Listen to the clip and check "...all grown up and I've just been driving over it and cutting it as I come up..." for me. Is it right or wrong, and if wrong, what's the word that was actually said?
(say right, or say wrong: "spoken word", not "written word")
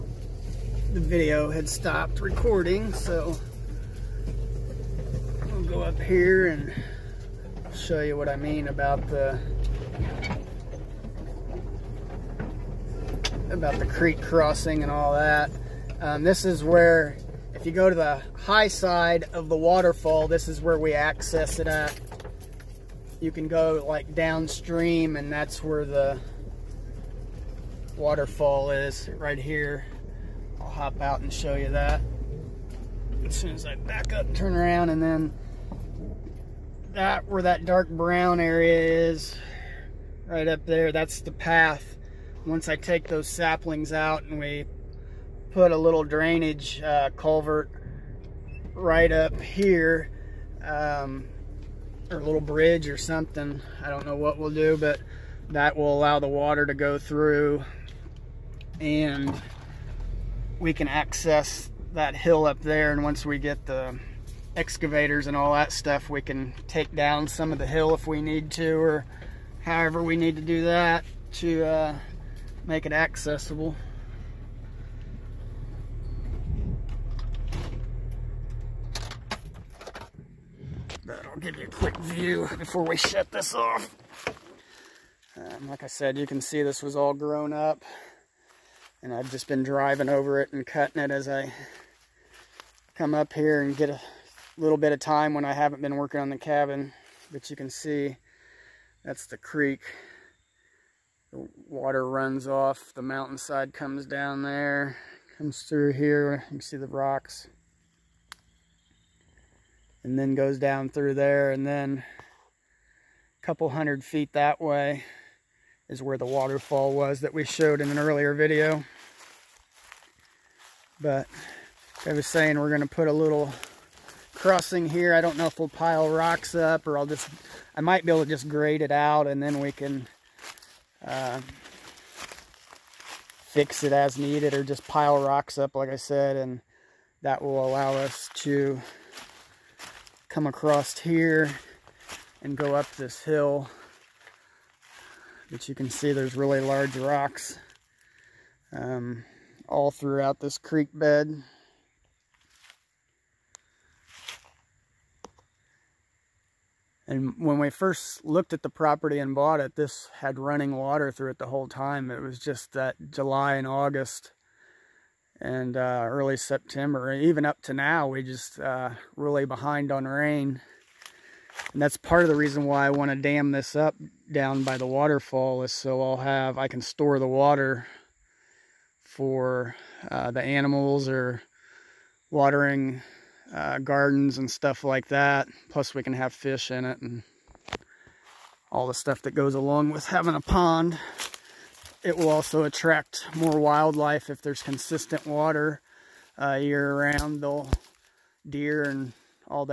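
right.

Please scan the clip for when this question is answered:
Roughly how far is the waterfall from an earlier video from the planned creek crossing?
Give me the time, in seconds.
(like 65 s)
113 s.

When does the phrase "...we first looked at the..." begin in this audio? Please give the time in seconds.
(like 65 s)
157 s.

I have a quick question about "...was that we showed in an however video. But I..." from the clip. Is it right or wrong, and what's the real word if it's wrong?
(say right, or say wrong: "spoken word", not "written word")
wrong: "earlier", not "however".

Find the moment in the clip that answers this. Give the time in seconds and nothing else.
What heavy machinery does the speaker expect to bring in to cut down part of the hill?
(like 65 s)
64 s.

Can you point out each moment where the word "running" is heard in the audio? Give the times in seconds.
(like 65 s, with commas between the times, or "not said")
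160 s.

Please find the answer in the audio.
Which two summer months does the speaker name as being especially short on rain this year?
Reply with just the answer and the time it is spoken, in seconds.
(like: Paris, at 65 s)
July and August, at 163 s.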